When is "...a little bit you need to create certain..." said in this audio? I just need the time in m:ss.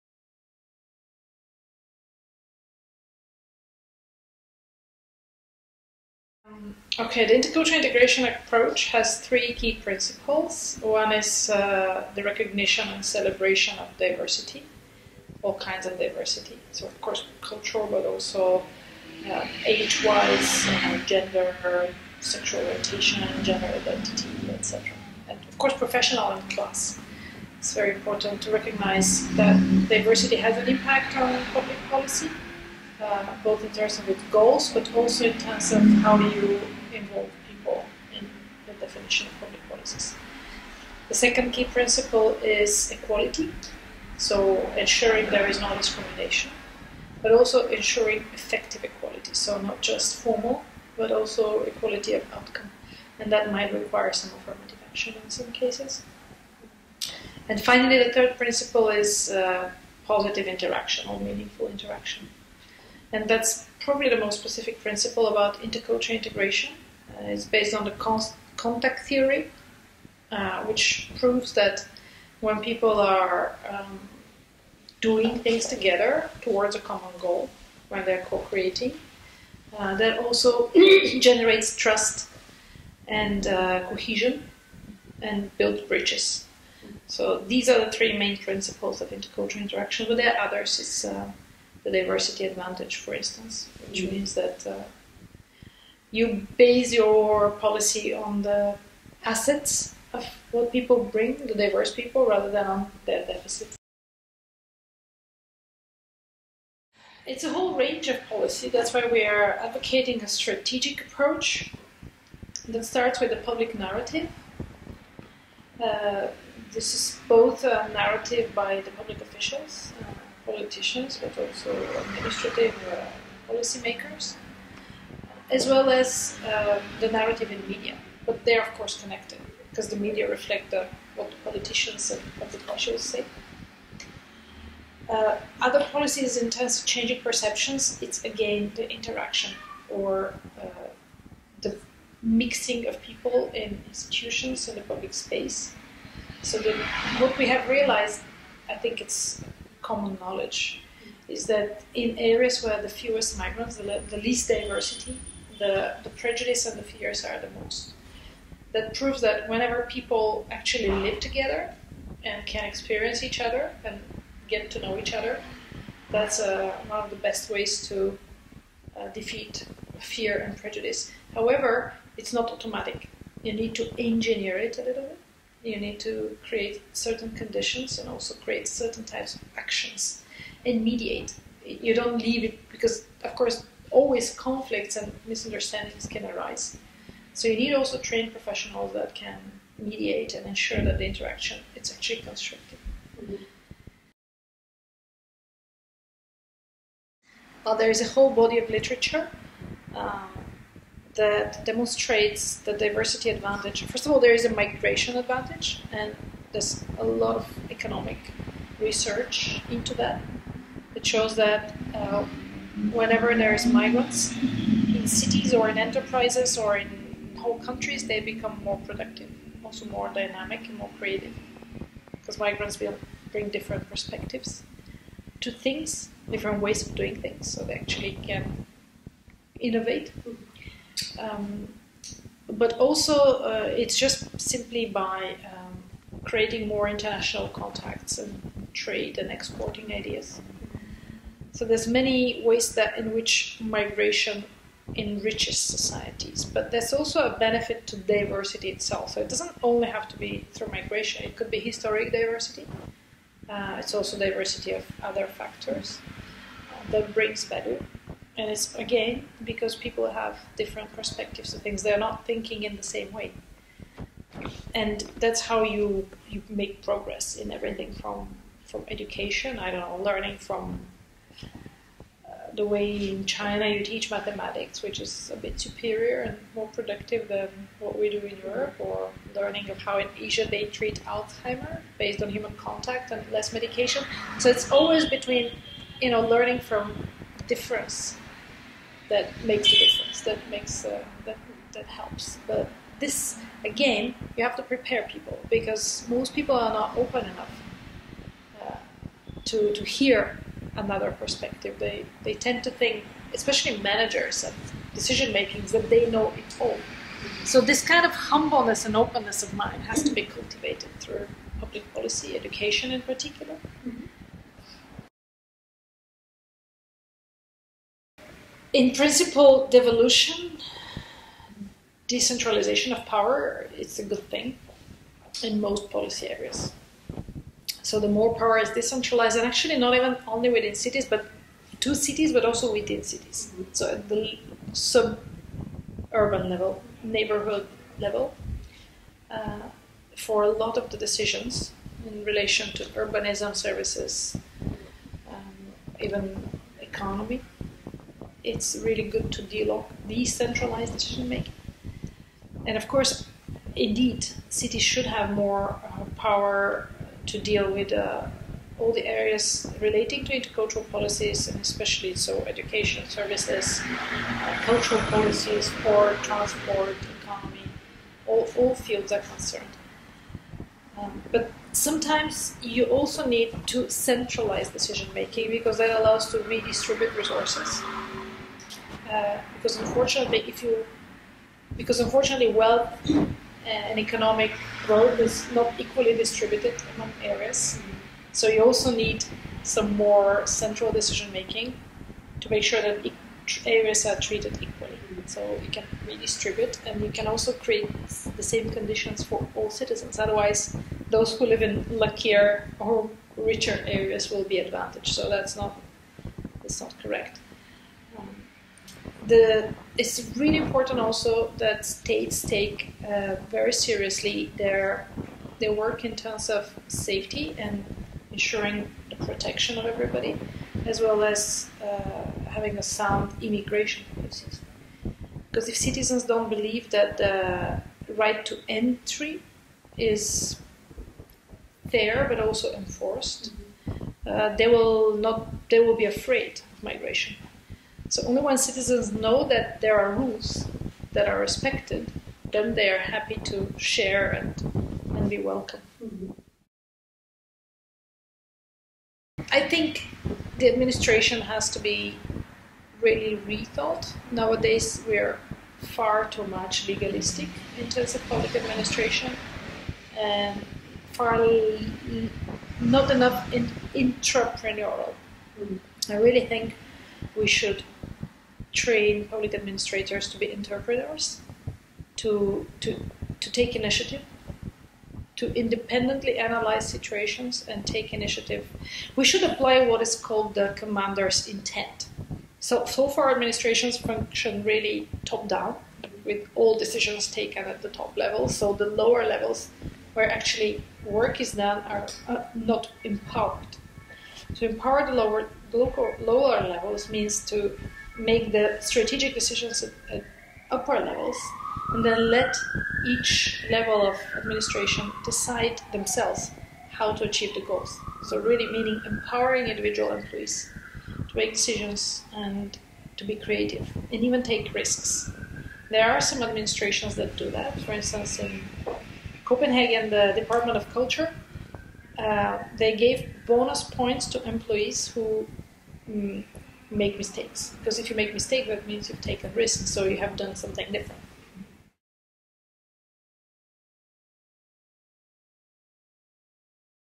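2:54.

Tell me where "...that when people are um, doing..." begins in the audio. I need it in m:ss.
1:11.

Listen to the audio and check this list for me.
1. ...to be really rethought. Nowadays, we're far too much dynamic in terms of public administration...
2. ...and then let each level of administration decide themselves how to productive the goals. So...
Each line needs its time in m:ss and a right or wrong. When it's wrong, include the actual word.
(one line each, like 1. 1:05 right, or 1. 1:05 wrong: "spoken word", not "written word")
1. 7:31 wrong: "legalistic", not "dynamic"
2. 8:21 wrong: "achieve", not "productive".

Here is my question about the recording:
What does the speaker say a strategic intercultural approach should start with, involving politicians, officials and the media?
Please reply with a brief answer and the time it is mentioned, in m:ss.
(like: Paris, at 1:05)
a public narrative, at 1:53.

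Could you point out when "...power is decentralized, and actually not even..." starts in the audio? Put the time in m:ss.
5:28.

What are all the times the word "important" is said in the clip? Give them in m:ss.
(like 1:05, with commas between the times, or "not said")
0:27, 6:50.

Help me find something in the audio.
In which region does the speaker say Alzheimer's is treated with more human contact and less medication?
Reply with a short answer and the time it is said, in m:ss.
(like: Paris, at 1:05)
Asia, at 4:40.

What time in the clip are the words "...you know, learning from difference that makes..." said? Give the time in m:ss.
4:46.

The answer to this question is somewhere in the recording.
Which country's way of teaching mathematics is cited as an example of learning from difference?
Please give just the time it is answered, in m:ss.
4:33.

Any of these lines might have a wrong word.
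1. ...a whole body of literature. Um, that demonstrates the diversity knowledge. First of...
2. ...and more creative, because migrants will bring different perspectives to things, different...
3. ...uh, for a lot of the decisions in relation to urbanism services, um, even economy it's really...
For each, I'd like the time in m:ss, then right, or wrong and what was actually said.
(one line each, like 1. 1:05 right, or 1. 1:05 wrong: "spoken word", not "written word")
1. 3:18 wrong: "advantage", not "knowledge"
2. 3:40 right
3. 5:39 right.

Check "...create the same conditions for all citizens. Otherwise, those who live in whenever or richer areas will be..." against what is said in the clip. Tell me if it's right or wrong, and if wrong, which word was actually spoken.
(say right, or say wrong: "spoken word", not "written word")
wrong: "luckier", not "whenever".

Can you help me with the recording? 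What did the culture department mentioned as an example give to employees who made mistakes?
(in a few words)
bonus points.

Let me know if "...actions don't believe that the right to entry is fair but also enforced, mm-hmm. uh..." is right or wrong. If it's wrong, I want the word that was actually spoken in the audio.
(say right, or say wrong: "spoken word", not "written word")
wrong: "citizens", not "actions".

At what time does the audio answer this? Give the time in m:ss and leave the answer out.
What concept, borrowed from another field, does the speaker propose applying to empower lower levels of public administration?
8:00.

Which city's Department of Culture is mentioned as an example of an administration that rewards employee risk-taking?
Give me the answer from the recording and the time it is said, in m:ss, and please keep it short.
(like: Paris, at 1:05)
Copenhagen, at 8:39.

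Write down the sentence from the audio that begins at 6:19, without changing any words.
Uh, because unfortunately, if you, because unfortunately, wealth uh, and economic growth is not equally distributed among areas.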